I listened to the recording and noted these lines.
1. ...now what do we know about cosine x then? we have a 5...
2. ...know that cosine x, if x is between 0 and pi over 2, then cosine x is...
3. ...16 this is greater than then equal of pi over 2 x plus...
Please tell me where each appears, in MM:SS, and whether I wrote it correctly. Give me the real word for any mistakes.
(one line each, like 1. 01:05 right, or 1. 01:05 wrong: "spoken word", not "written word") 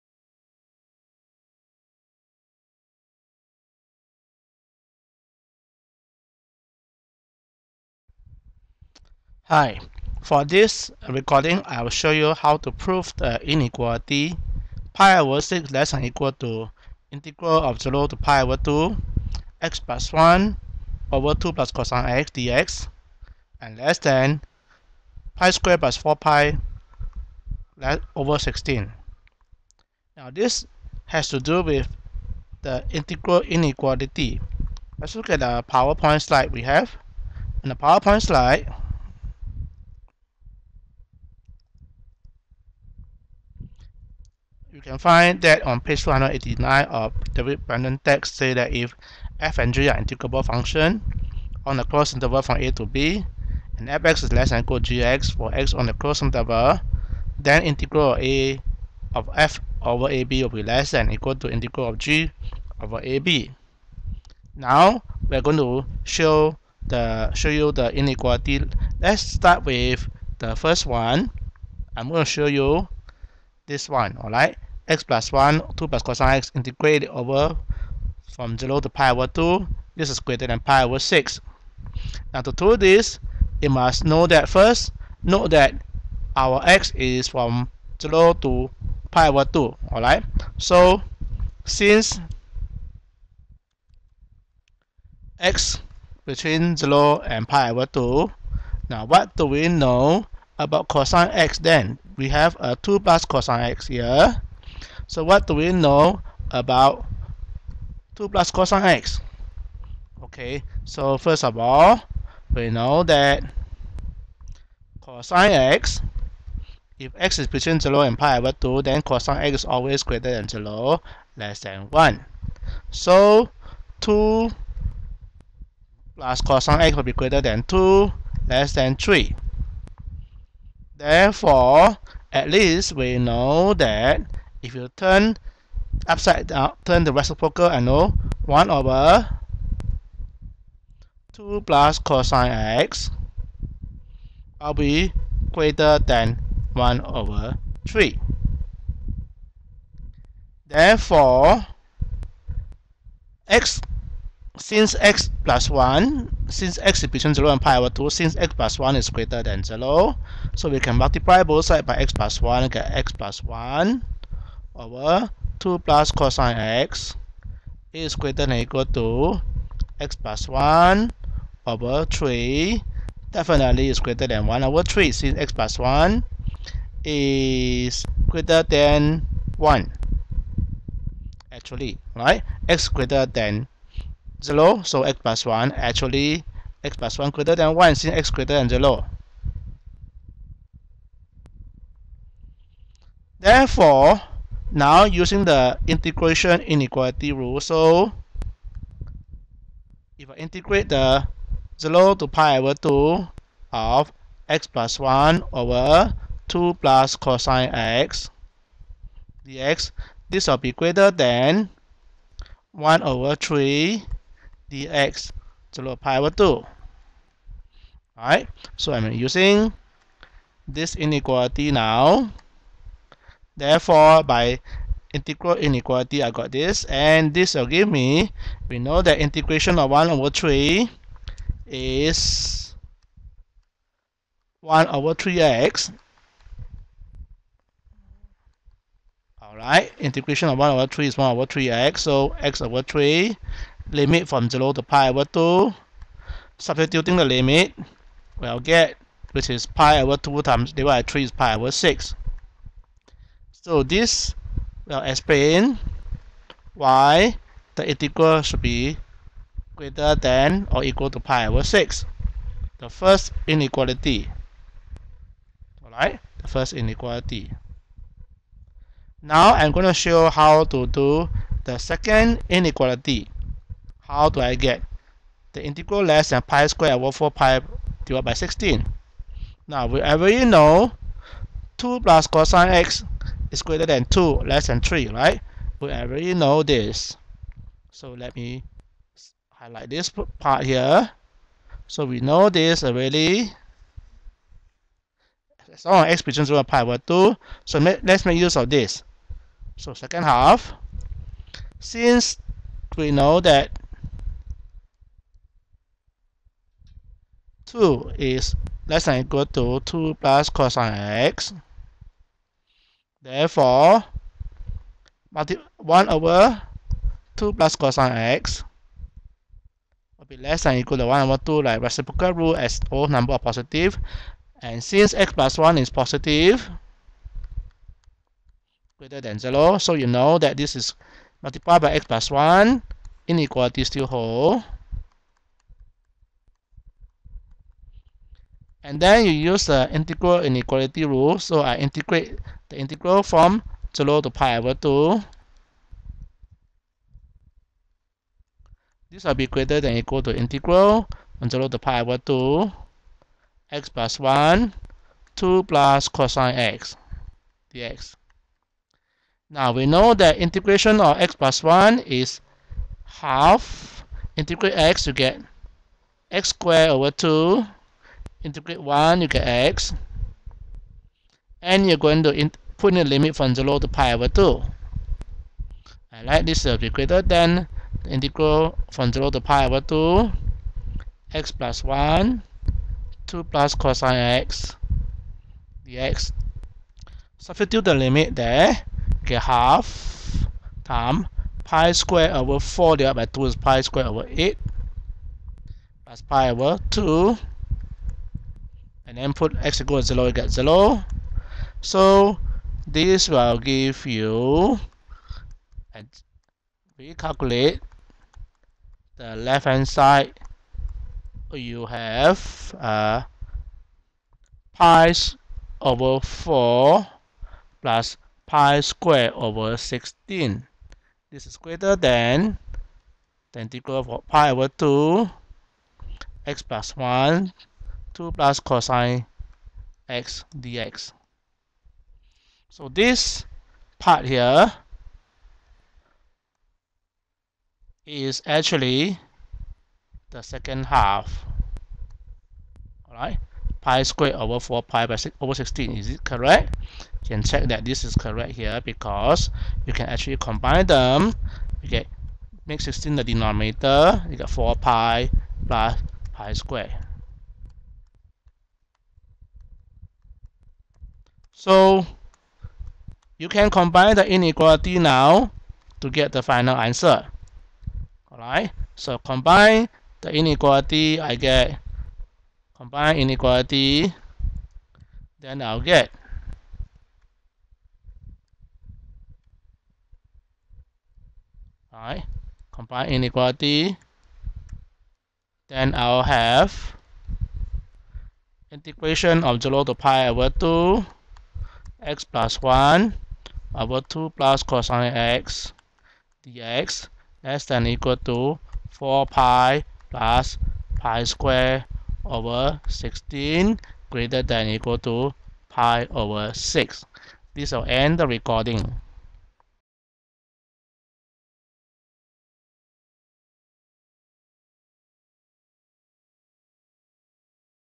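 1. 01:38 wrong: "2", not "5"
2. 01:52 right
3. 06:59 right.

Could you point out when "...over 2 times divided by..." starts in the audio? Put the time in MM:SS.
04:10.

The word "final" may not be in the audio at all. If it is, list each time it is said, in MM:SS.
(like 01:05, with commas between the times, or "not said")
07:46.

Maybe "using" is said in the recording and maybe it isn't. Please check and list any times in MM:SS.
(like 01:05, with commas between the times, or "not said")
03:15, 03:39.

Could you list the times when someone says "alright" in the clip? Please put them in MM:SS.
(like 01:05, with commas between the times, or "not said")
01:14, 01:29, 03:38, 03:59, 04:25, 07:23, 07:48, 08:01.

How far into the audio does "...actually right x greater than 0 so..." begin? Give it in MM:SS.
03:01.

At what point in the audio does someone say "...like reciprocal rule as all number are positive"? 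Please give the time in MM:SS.
05:21.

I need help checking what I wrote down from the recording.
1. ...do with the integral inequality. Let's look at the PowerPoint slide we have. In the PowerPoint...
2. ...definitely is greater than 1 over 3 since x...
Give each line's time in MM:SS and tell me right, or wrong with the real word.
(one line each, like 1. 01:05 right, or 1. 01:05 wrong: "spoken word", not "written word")
1. 00:31 right
2. 02:53 right.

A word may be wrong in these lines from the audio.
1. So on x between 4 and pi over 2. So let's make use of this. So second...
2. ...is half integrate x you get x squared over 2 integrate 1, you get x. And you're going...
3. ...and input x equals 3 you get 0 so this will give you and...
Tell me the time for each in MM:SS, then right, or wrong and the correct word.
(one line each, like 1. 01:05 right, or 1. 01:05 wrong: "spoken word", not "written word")
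1. 04:55 wrong: "0", not "4"
2. 06:01 right
3. 06:39 wrong: "0", not "3".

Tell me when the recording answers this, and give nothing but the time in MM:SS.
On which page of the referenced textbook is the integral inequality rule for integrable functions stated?
00:45.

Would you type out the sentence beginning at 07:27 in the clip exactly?
You can check that this is correct here because you can actually combine them.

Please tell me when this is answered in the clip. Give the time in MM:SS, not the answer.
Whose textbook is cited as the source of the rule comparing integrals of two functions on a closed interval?
00:47.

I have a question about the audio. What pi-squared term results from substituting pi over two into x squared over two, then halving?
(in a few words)
pi squared over 8.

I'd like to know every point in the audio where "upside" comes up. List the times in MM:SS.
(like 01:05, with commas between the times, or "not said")
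02:16.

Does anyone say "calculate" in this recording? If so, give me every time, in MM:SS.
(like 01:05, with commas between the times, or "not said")
06:47.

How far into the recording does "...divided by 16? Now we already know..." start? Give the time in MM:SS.
04:38.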